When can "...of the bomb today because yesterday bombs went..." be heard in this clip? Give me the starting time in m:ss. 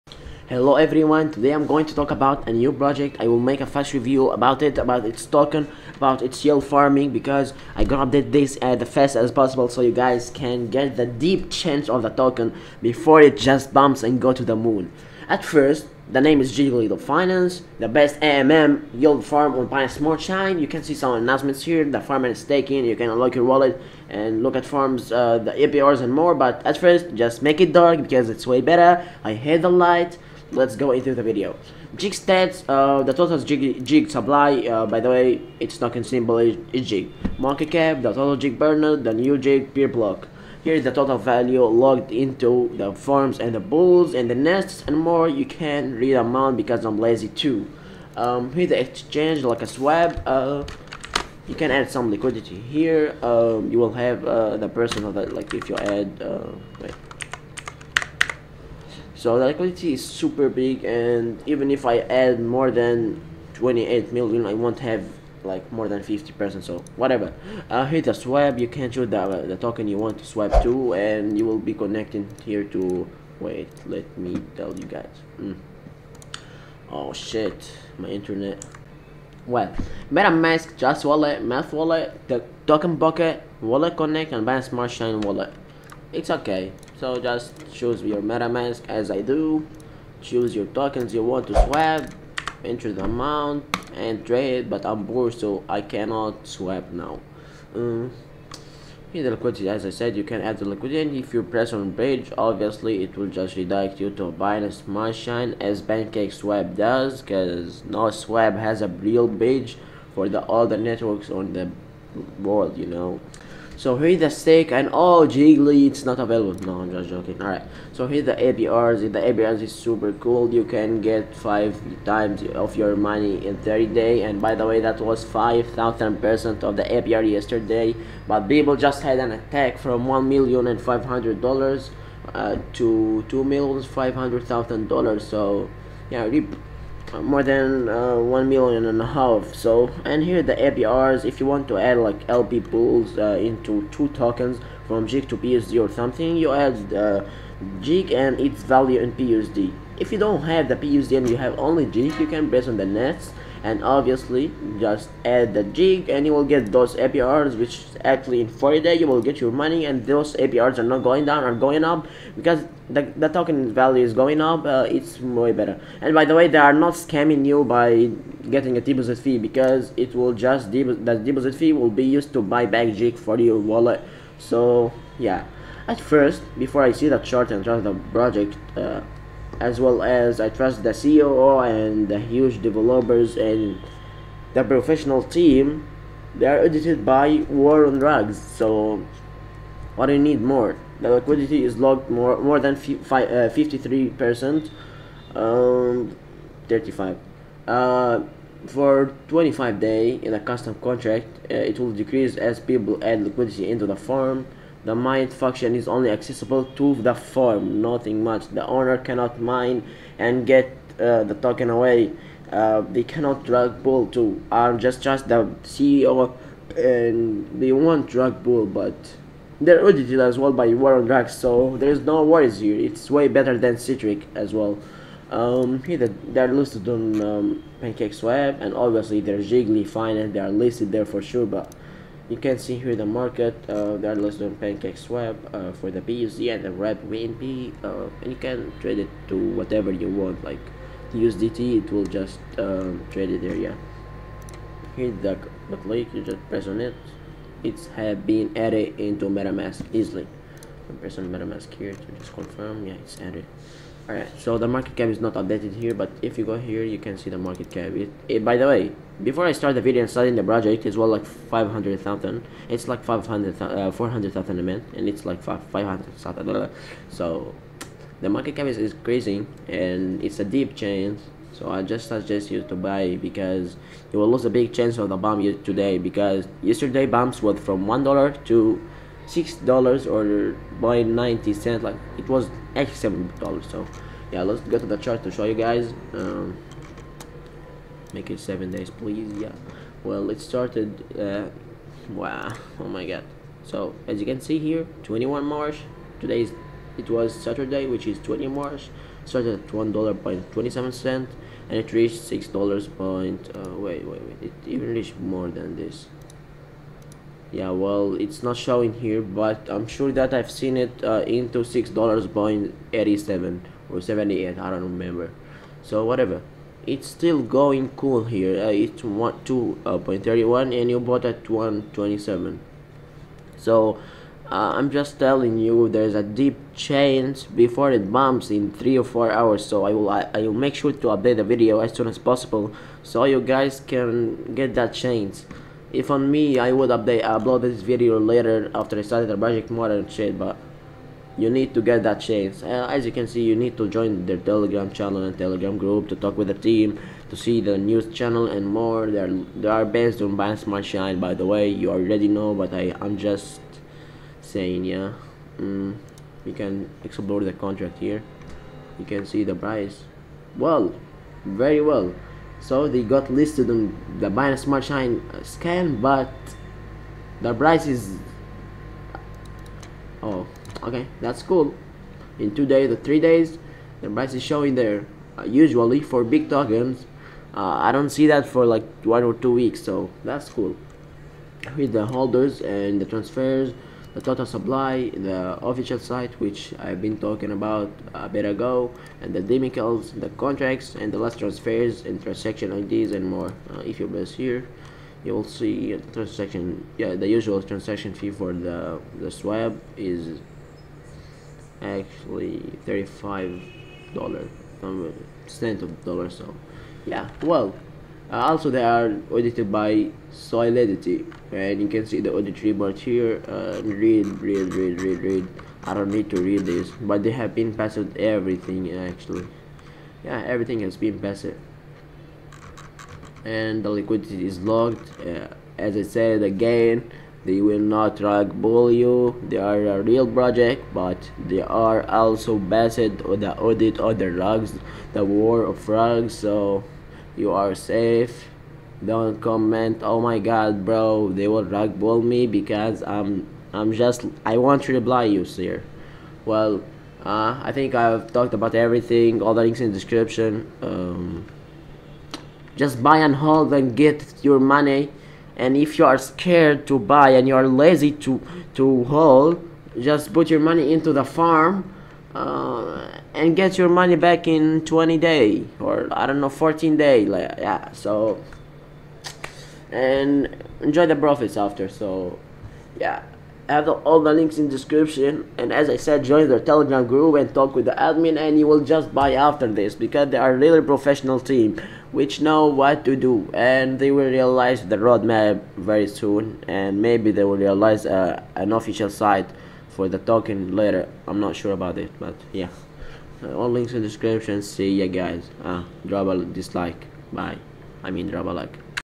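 4:34.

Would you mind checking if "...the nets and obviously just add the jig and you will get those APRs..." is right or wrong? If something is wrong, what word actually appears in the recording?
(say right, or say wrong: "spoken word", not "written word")
right.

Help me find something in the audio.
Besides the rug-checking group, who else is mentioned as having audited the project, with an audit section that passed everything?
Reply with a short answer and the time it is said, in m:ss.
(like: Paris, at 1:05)
Solidity, at 6:50.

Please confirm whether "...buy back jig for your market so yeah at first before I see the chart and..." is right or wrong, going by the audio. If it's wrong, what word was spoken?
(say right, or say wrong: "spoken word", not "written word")
wrong: "wallet", not "market".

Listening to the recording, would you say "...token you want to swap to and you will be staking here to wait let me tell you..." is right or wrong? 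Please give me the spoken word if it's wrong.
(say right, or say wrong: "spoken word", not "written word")
wrong: "connecting", not "staking".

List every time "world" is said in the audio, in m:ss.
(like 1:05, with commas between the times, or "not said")
1:52.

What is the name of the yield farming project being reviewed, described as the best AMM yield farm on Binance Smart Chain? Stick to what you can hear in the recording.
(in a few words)
Jiggly Finance.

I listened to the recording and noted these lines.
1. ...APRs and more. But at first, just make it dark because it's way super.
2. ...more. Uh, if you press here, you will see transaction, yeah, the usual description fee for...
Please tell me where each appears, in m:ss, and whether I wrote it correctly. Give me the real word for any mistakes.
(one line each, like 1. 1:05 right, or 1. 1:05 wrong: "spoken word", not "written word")
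1. 0:25 wrong: "better", not "super"
2. 6:33 wrong: "transaction", not "description".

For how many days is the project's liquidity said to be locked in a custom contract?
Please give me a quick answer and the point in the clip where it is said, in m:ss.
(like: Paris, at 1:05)
25, at 3:19.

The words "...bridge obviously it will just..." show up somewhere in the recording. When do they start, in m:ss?
1:41.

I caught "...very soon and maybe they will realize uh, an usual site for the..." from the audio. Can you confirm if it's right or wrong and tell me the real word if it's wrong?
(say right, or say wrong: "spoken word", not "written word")
wrong: "official", not "usual".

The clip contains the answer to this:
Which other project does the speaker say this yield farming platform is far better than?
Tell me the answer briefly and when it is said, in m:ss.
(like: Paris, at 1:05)
Citric, at 3:43.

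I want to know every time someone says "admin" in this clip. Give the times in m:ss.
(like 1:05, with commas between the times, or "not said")
7:57.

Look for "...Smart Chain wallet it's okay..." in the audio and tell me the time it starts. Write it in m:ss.
1:24.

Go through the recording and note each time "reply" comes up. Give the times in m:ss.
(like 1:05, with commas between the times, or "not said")
7:24.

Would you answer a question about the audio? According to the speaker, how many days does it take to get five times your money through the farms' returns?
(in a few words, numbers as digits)
30.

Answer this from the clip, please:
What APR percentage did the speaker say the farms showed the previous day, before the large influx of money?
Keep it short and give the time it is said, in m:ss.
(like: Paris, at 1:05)
5,000%, at 2:05.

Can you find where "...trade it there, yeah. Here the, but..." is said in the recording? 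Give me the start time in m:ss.
4:03.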